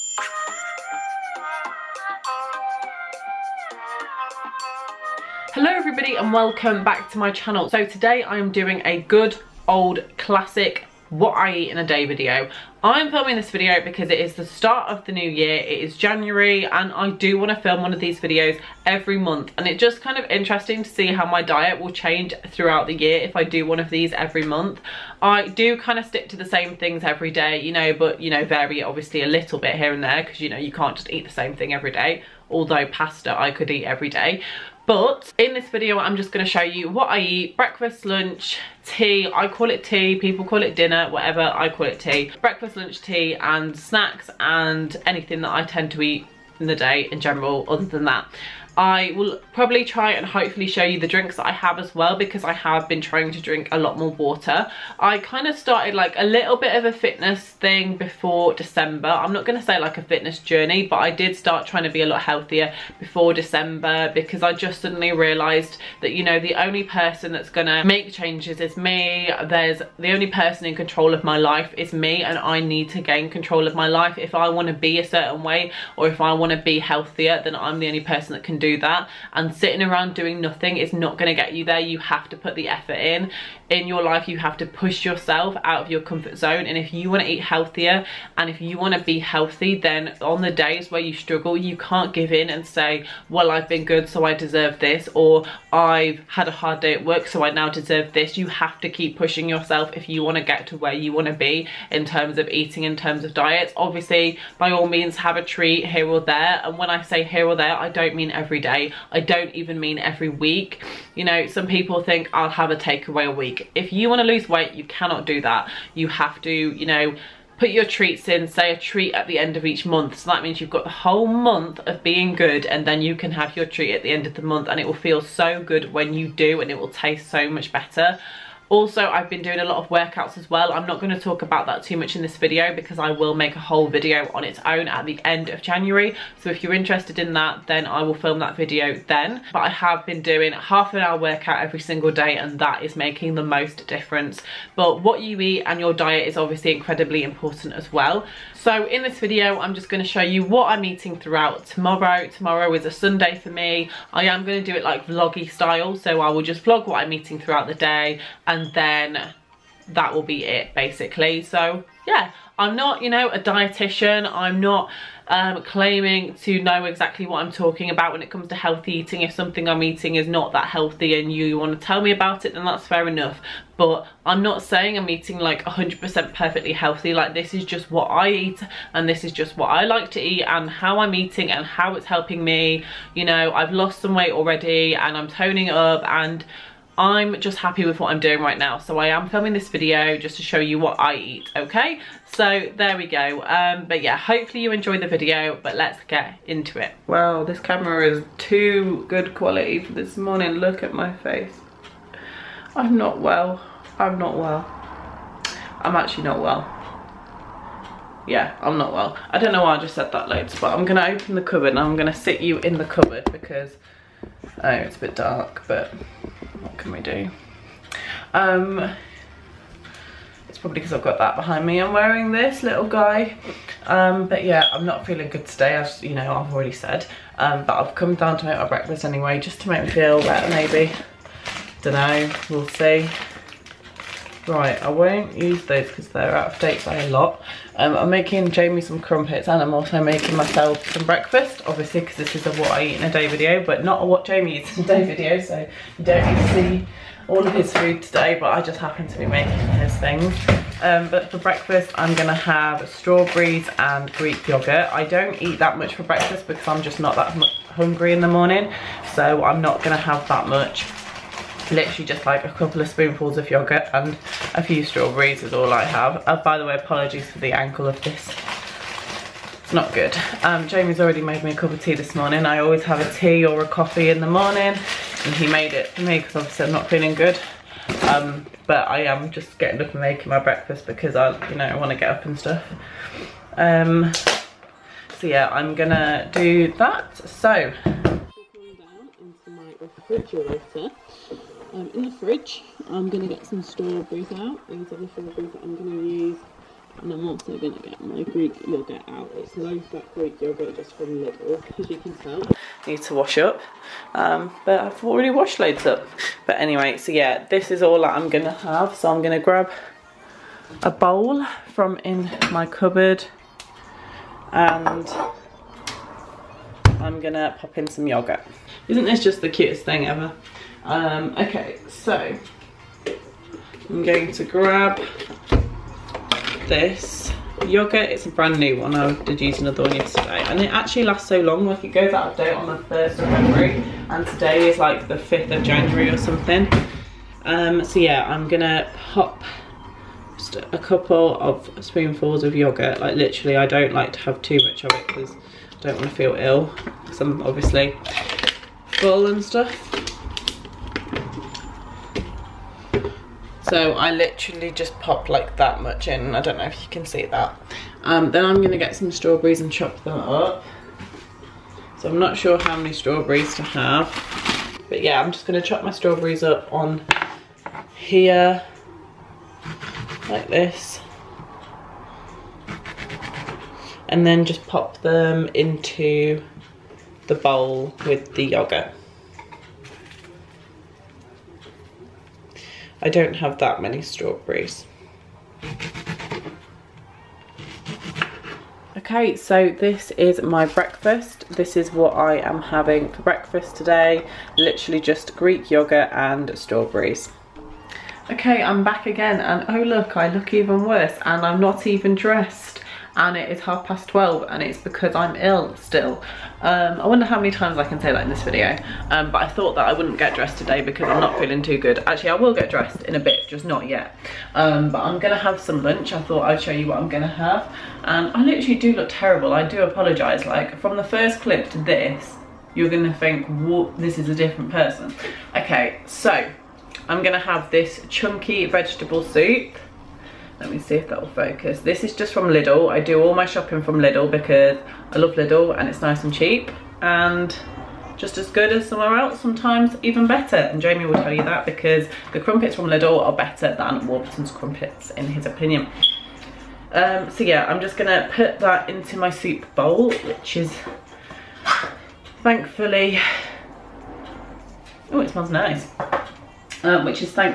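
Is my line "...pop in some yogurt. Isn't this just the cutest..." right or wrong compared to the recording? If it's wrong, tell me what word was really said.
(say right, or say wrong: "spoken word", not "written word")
right.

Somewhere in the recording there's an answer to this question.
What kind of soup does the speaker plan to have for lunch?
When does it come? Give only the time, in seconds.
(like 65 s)
428 s.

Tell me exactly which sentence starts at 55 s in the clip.
I kind of started like a little bit of a fitness thing before December.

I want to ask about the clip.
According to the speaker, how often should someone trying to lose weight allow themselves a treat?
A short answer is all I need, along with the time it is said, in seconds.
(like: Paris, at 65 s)
End of each month, at 119 s.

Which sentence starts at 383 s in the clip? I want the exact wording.
I don't have that many strawberries.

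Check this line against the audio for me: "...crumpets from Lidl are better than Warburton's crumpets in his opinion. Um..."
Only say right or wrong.
right.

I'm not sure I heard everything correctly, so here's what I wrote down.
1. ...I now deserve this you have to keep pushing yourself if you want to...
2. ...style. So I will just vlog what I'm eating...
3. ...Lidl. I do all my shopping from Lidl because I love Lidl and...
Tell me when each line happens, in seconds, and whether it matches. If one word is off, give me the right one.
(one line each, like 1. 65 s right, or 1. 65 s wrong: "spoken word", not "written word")
1. 97 s right
2. 155 s right
3. 432 s right.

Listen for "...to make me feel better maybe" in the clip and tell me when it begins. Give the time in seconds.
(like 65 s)
229 s.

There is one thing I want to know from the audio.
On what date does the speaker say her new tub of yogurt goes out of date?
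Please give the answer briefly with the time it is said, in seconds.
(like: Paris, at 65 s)
1st of February, at 332 s.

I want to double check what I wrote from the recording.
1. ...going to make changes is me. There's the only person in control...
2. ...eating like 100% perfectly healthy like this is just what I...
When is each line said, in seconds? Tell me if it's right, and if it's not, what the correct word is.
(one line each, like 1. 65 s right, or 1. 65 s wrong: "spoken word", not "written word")
1. 67 s right
2. 175 s right.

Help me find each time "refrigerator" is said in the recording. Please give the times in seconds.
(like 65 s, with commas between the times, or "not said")
289 s.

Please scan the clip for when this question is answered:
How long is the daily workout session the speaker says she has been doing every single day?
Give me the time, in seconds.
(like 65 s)
140 s.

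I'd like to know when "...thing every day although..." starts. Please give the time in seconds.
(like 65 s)
31 s.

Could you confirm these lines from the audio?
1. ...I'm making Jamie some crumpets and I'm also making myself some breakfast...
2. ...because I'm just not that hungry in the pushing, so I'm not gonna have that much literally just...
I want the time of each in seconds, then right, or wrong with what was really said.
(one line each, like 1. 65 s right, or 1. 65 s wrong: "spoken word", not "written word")
1. 237 s right
2. 256 s wrong: "morning", not "pushing".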